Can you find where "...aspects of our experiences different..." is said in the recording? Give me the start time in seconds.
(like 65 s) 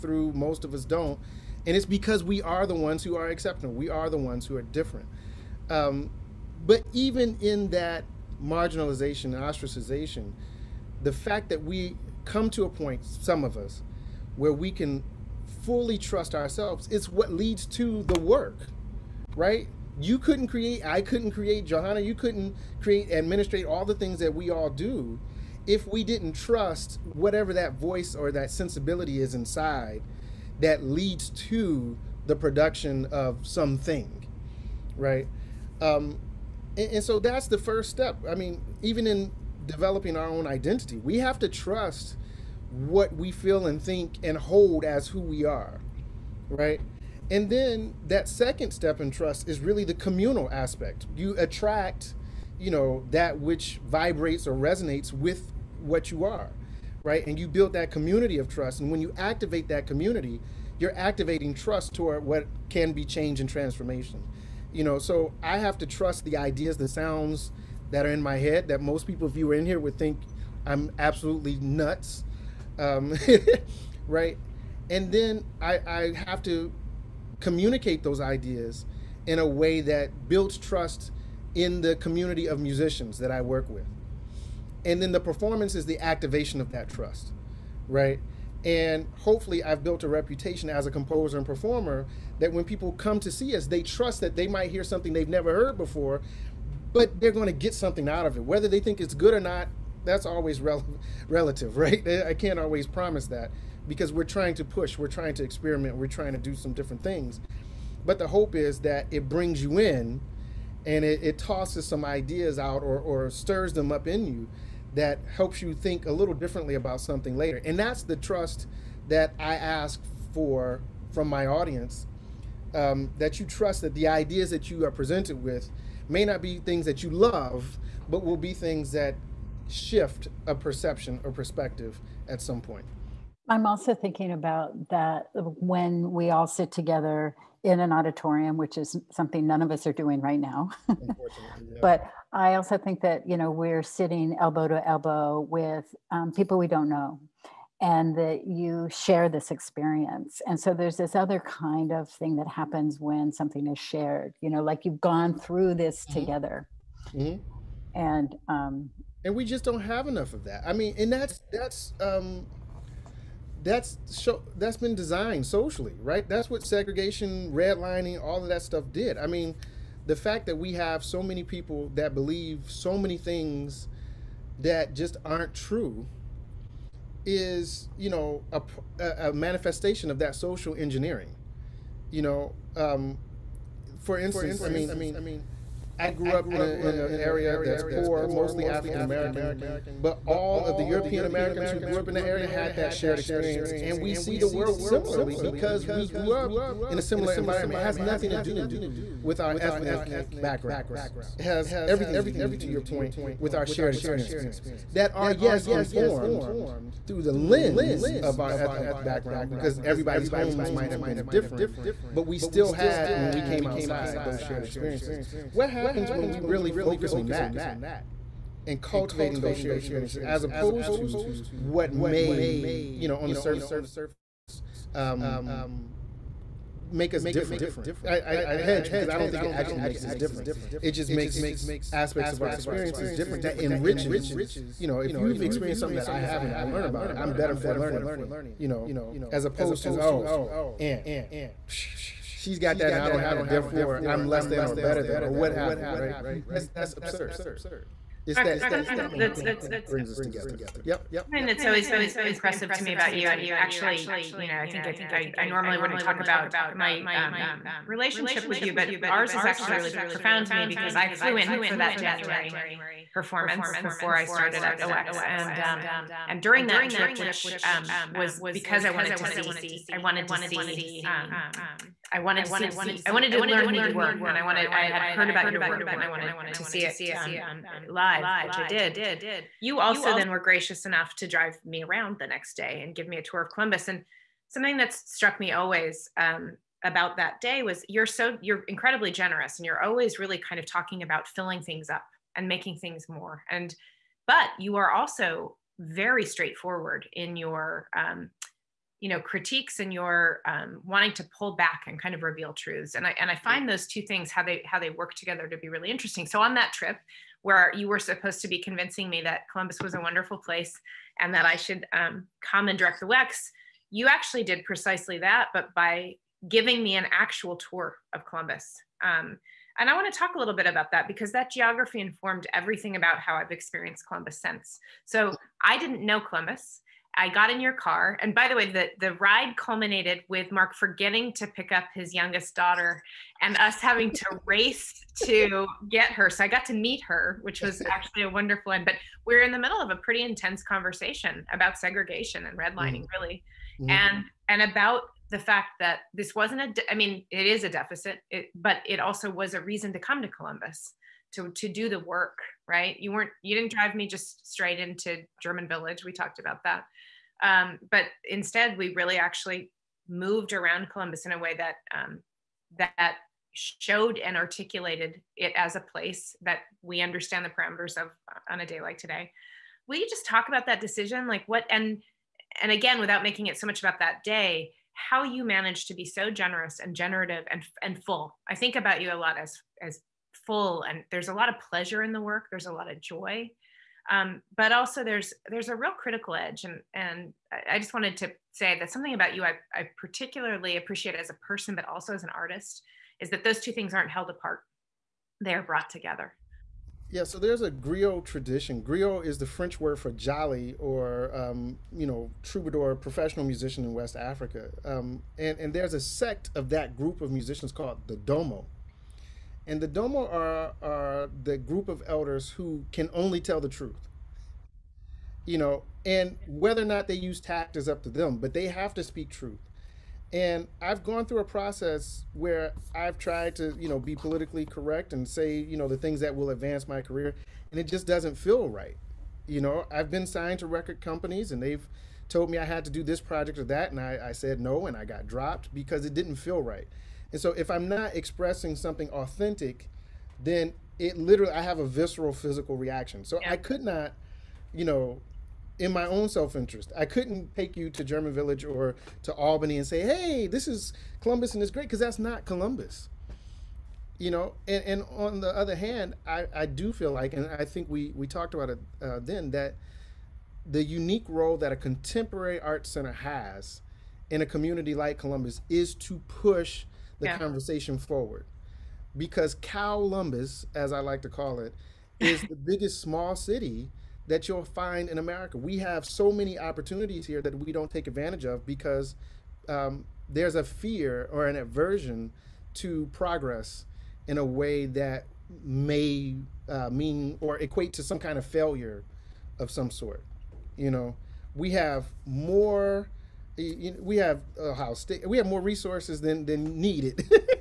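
231 s.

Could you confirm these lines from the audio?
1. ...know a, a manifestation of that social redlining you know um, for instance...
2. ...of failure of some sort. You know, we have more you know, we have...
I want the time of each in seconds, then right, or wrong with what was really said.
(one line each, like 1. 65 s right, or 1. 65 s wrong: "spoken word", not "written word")
1. 178 s wrong: "engineering", not "redlining"
2. 488 s right.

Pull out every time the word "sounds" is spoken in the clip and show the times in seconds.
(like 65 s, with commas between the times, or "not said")
66 s.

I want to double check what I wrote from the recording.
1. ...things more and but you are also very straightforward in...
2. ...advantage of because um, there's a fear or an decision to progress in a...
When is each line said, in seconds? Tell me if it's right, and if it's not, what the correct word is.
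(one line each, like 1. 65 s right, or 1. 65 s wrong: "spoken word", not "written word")
1. 292 s right
2. 478 s wrong: "aversion", not "decision".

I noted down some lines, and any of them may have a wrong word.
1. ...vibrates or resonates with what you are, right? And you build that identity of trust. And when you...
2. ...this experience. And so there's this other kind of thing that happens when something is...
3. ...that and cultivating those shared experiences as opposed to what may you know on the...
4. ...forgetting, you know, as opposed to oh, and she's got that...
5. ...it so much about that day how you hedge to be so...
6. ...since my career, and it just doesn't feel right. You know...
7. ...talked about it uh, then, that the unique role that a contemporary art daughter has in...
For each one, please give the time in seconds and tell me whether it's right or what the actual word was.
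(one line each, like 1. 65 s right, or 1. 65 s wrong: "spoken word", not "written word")
1. 53 s wrong: "community", not "identity"
2. 149 s right
3. 217 s right
4. 237 s wrong: "learning", not "forgetting"
5. 373 s wrong: "manage", not "hedge"
6. 426 s wrong: "advance", not "since"
7. 458 s wrong: "center", not "daughter".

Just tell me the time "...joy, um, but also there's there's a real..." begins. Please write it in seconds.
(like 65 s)
383 s.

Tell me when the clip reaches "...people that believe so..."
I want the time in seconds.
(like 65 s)
171 s.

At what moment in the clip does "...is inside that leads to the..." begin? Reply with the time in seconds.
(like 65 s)
29 s.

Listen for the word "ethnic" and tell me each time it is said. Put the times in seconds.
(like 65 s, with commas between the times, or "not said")
199 s, 208 s.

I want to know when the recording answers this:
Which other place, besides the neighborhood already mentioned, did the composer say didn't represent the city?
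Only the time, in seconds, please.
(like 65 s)
449 s.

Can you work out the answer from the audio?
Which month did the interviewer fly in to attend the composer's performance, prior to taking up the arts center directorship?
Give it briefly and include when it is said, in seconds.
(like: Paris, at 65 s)
January, at 261 s.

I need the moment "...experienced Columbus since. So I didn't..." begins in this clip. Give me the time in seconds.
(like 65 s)
323 s.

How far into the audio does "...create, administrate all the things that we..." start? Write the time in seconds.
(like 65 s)
22 s.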